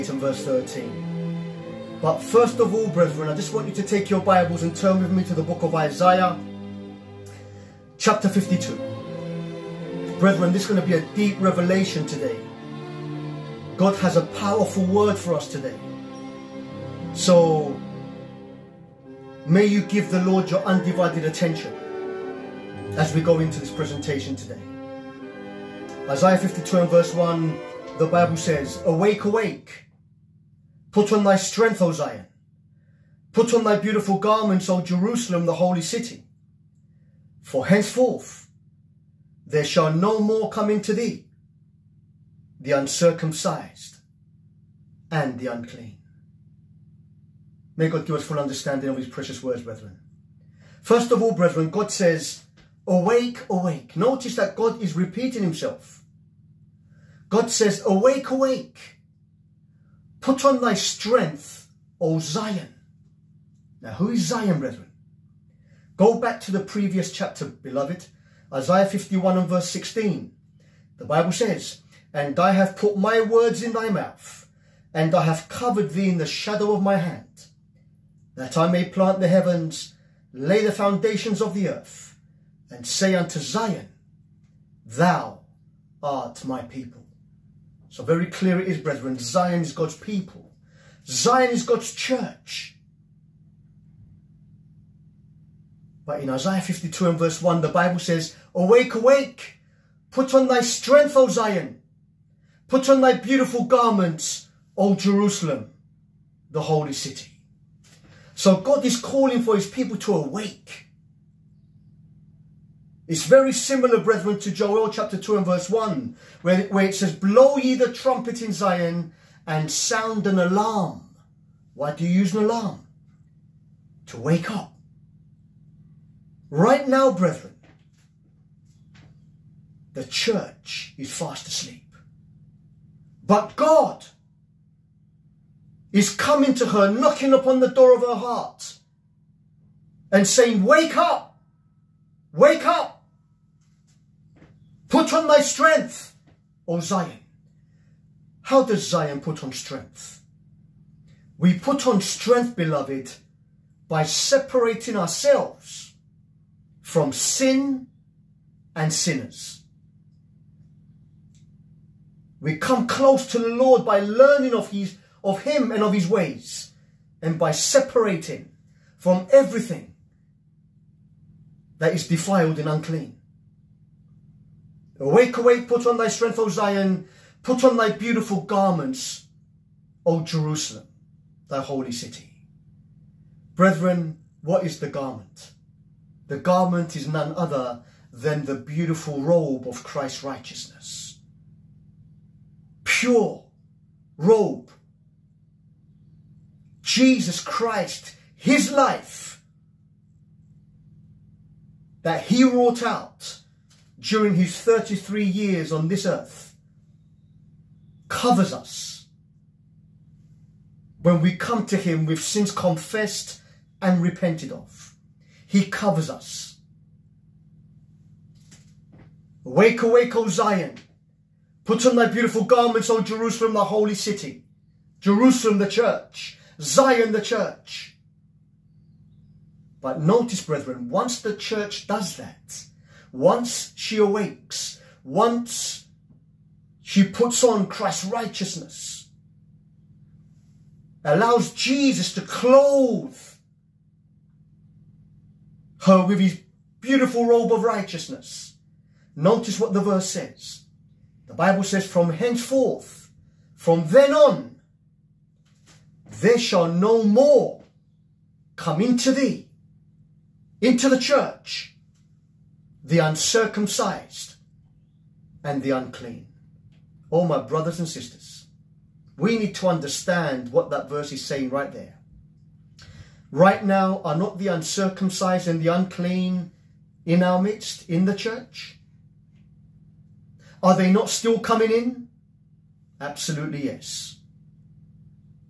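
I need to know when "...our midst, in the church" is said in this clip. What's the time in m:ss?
4:37.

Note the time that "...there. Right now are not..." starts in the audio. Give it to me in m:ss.
4:31.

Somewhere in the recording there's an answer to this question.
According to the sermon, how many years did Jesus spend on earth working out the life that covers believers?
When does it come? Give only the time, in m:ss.
3:24.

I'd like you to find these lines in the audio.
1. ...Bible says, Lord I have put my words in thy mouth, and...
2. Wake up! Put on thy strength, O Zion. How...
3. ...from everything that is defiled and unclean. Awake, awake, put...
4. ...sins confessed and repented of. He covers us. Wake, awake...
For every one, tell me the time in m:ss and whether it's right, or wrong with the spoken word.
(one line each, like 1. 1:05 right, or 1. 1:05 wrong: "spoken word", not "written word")
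1. 1:11 wrong: "And", not "Lord"
2. 2:22 right
3. 2:48 right
4. 3:32 right.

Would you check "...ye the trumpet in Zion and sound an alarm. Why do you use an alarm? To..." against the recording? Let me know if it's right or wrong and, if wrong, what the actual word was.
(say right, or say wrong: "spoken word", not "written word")
right.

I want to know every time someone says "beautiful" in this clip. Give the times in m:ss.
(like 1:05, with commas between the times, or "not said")
0:33, 1:43, 2:57, 3:08, 3:42, 4:06.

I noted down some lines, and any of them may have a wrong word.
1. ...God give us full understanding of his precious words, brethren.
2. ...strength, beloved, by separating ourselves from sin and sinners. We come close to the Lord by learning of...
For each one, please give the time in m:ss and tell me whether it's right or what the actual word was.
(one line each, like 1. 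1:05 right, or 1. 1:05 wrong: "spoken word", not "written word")
1. 0:47 right
2. 2:31 right.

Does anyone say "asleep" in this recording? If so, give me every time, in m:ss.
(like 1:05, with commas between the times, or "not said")
2:11.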